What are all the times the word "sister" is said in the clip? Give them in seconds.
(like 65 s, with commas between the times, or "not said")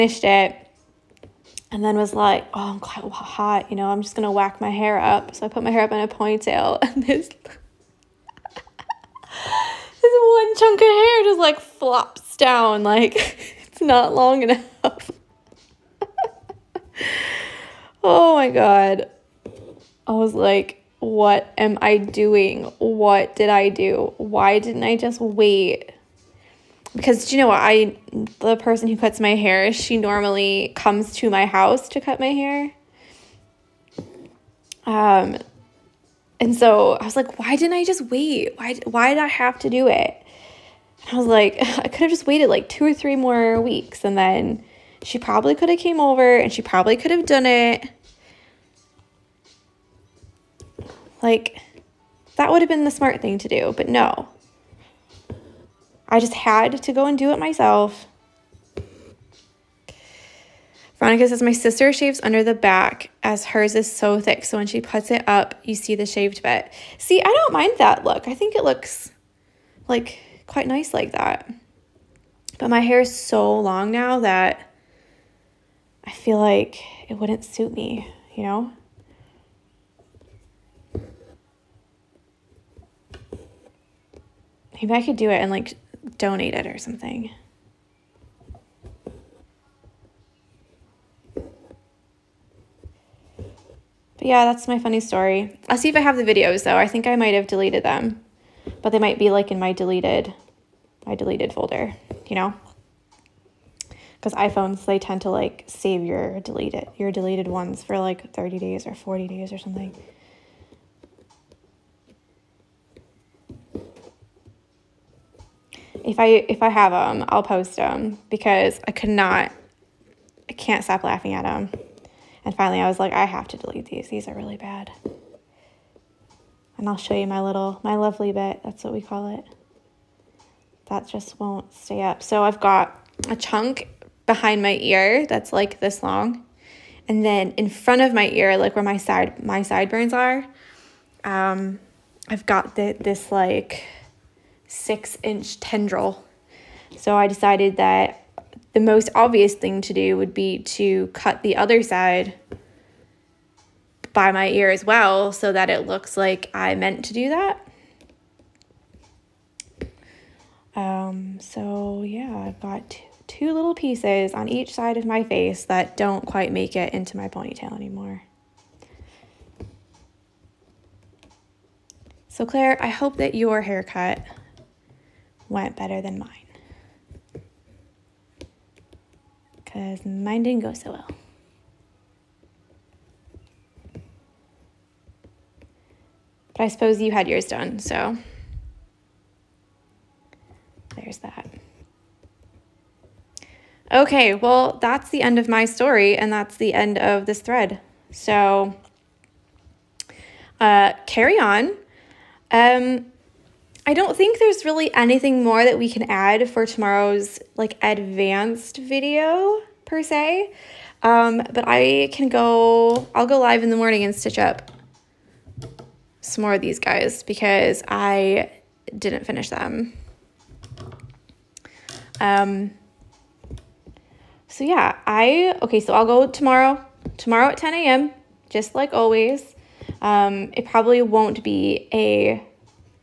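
61 s.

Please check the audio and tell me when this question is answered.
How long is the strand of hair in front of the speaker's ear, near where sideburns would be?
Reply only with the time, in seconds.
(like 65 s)
144 s.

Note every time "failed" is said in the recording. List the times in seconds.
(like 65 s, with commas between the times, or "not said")
not said.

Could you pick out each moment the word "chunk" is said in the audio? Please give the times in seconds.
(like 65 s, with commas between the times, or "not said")
10 s, 133 s.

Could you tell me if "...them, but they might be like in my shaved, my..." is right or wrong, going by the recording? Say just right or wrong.
wrong.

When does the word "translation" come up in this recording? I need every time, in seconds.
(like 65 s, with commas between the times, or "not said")
not said.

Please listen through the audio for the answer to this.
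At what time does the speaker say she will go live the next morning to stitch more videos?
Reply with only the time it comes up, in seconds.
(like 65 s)
227 s.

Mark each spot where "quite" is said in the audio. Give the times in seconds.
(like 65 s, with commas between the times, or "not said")
2 s, 70 s, 166 s.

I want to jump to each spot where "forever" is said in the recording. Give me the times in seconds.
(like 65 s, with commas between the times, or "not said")
not said.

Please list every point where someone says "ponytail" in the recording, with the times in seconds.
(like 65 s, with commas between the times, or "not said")
6 s, 167 s.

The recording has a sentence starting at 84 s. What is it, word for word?
Maybe I could do it and like donate it or something.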